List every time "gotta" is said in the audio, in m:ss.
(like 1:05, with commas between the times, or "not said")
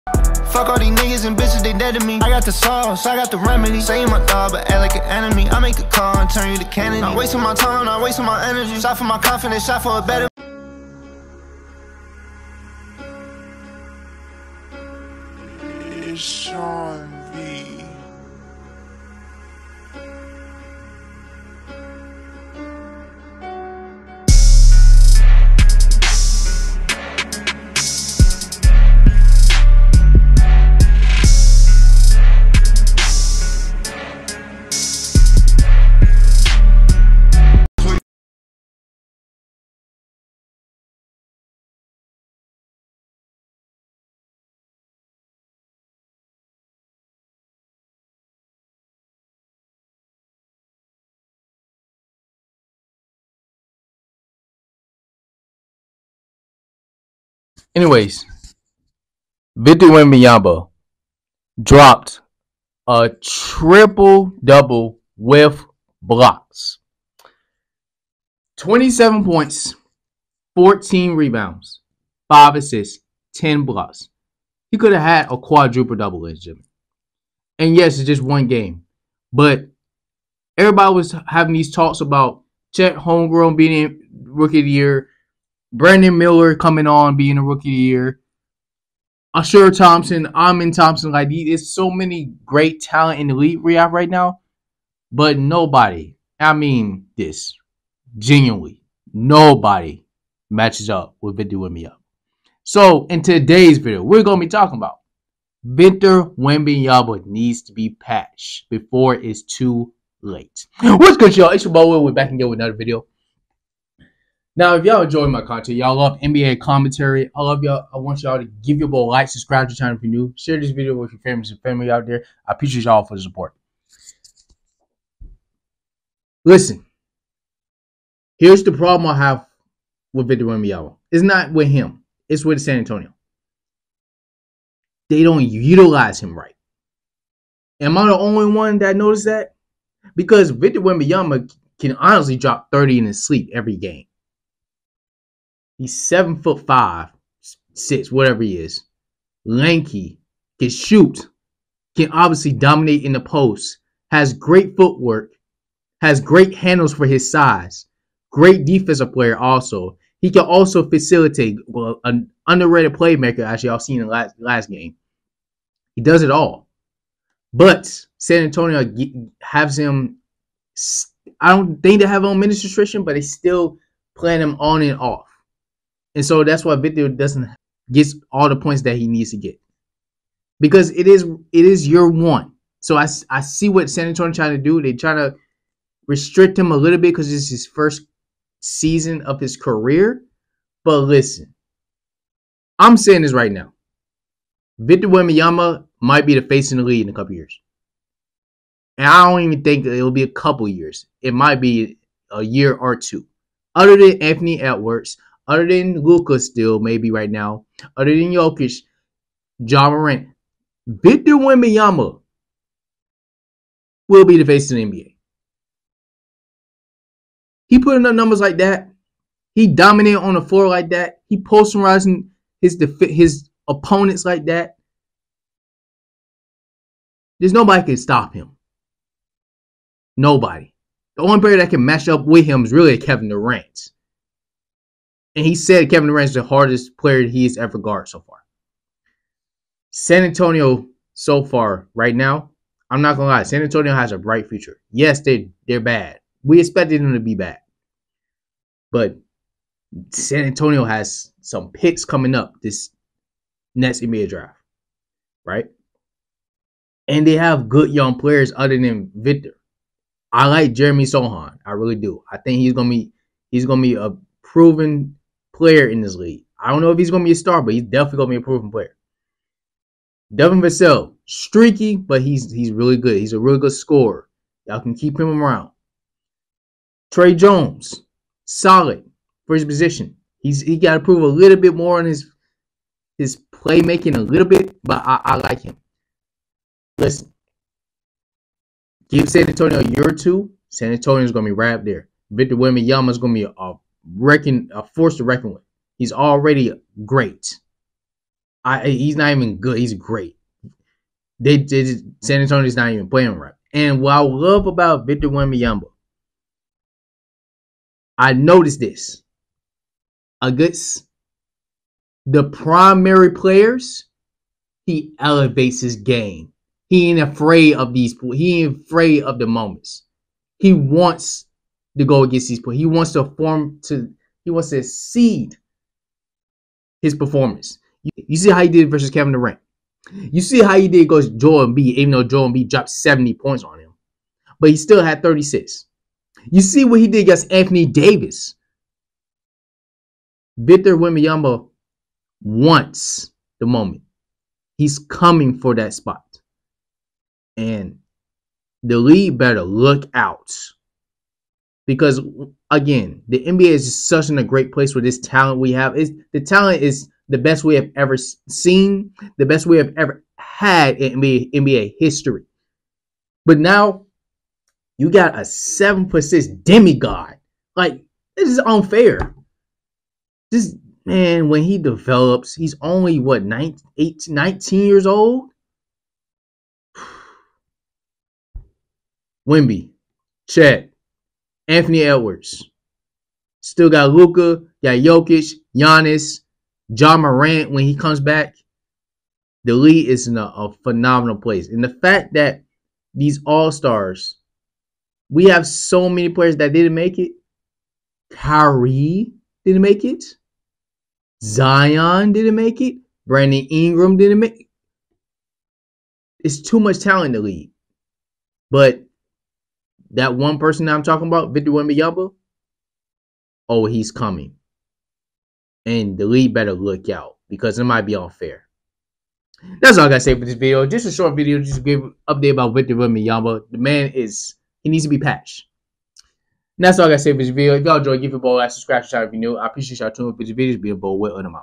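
7:00, 7:07.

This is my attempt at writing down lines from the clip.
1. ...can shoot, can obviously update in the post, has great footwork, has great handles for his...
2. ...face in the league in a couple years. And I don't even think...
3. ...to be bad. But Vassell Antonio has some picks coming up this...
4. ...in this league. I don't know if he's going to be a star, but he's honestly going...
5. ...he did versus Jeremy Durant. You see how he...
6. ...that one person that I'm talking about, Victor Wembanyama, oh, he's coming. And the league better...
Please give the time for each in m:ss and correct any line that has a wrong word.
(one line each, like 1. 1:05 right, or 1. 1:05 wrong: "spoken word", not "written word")
1. 2:30 wrong: "dominate", not "update"
2. 3:16 right
3. 4:07 wrong: "San", not "Vassell"
4. 4:25 wrong: "definitely", not "honestly"
5. 5:28 wrong: "Kevin", not "Jeremy"
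6. 6:50 right.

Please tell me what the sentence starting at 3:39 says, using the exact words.
He dominated on the floor like that.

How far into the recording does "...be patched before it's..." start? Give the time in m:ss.
1:47.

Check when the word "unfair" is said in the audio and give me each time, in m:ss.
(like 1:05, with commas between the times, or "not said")
6:08, 6:58.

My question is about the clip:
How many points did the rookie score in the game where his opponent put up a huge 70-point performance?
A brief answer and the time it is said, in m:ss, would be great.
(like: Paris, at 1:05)
36, at 5:35.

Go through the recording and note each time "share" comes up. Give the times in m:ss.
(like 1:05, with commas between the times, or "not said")
2:00, 7:09.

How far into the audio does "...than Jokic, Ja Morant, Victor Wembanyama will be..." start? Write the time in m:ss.
3:28.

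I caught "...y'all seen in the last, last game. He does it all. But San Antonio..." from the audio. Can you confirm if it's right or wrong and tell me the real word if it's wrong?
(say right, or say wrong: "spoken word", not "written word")
right.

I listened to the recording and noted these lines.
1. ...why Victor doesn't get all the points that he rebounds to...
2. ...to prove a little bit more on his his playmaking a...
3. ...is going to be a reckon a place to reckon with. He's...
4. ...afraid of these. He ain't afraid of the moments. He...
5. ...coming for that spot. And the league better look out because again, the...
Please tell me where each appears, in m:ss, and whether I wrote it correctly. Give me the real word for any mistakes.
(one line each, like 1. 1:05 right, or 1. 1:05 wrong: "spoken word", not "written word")
1. 2:56 wrong: "needs", not "rebounds"
2. 4:40 right
3. 4:53 wrong: "force", not "place"
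4. 5:17 right
5. 5:44 right.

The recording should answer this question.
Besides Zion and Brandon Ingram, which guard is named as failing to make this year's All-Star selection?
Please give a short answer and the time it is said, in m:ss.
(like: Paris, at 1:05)
Kyrie, at 6:38.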